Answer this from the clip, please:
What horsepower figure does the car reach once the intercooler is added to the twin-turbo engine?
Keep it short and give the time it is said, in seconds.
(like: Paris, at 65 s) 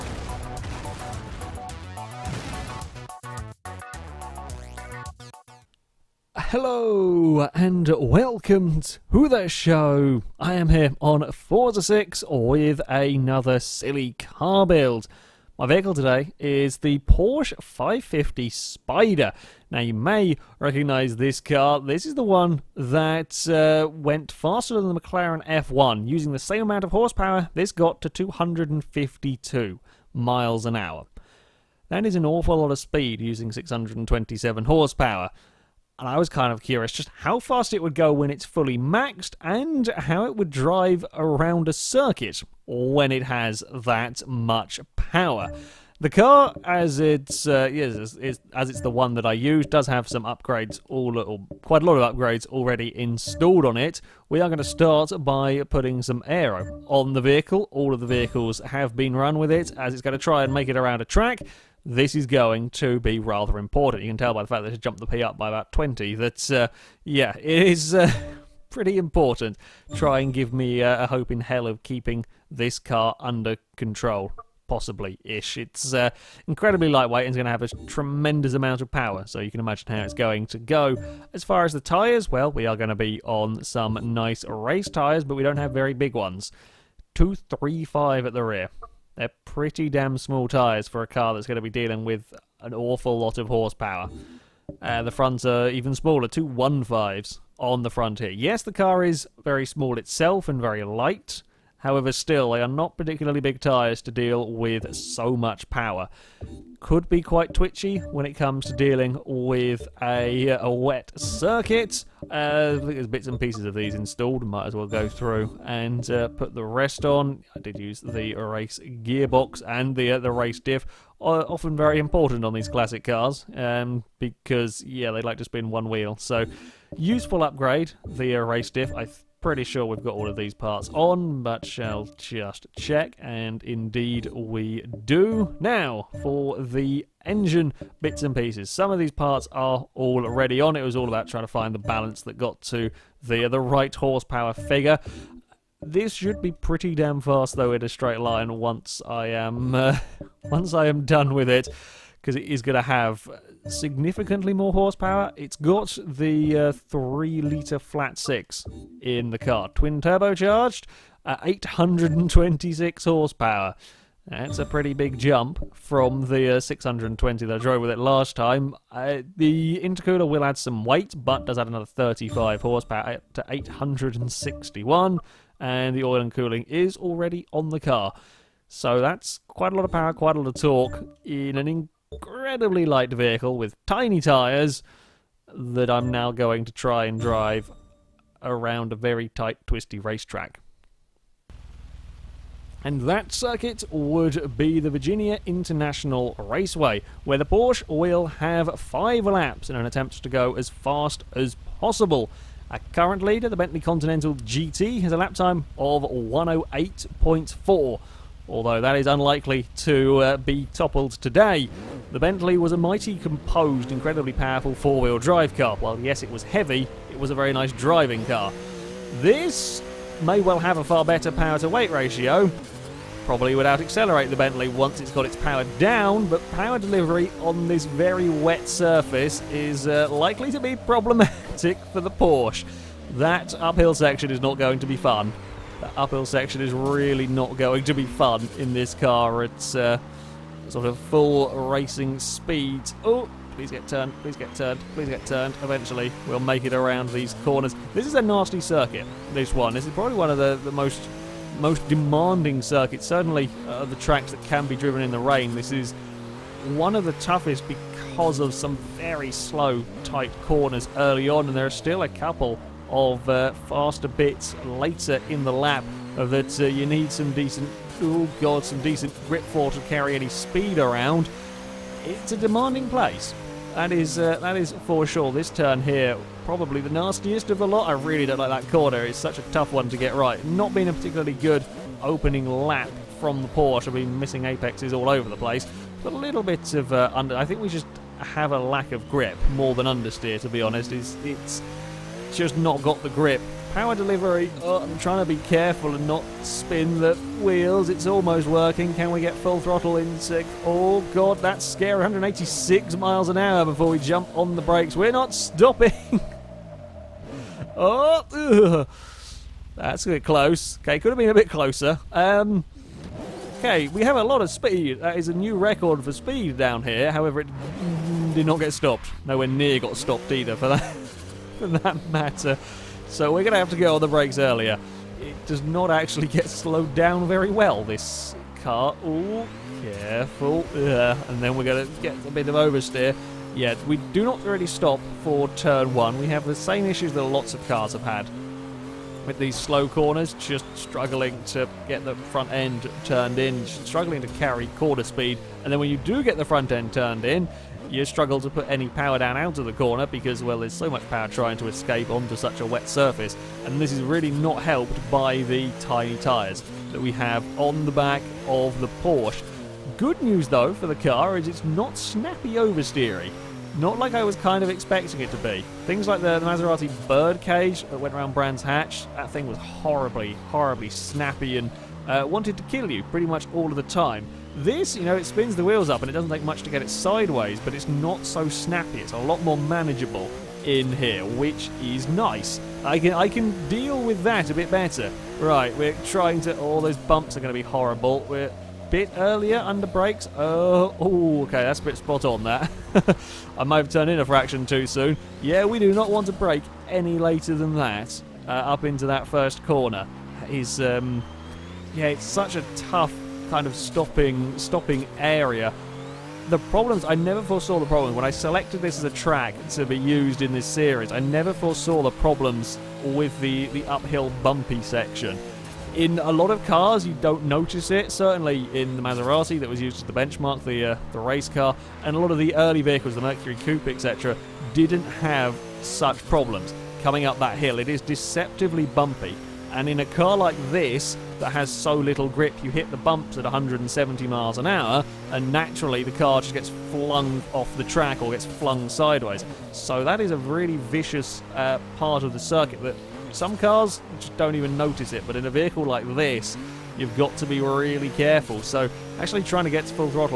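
861, at 173 s.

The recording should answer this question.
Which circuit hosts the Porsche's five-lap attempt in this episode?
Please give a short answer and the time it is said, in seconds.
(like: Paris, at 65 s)
Virginia International Raceway, at 194 s.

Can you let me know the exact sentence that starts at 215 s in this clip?
While yes, it was heavy, it was a very nice driving car.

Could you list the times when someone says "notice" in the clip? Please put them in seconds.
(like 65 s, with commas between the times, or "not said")
417 s, 444 s.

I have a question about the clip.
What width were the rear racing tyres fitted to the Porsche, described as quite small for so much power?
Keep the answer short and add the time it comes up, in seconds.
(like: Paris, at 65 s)
235, at 87 s.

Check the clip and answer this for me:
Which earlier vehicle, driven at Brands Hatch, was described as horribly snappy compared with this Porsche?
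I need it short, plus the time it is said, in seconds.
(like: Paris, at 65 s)
Maserati Birdcage, at 366 s.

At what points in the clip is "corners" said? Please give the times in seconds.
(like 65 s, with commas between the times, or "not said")
247 s, 260 s, 278 s, 339 s, 349 s, 399 s.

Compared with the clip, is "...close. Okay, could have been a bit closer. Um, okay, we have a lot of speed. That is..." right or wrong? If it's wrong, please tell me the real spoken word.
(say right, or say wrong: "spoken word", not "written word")
right.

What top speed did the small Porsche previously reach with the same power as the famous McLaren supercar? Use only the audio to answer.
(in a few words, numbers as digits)
252 miles an hour.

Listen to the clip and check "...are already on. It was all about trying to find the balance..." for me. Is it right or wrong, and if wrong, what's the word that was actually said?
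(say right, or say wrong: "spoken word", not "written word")
right.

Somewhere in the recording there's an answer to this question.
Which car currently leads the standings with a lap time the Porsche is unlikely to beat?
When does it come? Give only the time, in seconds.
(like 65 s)
203 s.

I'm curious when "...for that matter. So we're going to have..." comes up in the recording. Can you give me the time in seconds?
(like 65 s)
321 s.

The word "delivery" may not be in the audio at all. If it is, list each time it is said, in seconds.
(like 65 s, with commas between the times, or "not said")
226 s, 293 s.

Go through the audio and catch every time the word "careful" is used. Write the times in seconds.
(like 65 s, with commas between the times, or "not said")
295 s, 329 s, 448 s.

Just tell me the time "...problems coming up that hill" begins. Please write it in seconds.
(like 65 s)
426 s.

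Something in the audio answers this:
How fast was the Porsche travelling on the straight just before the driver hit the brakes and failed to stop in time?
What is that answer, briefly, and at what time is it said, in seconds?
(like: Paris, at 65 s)
186 miles an hour, at 302 s.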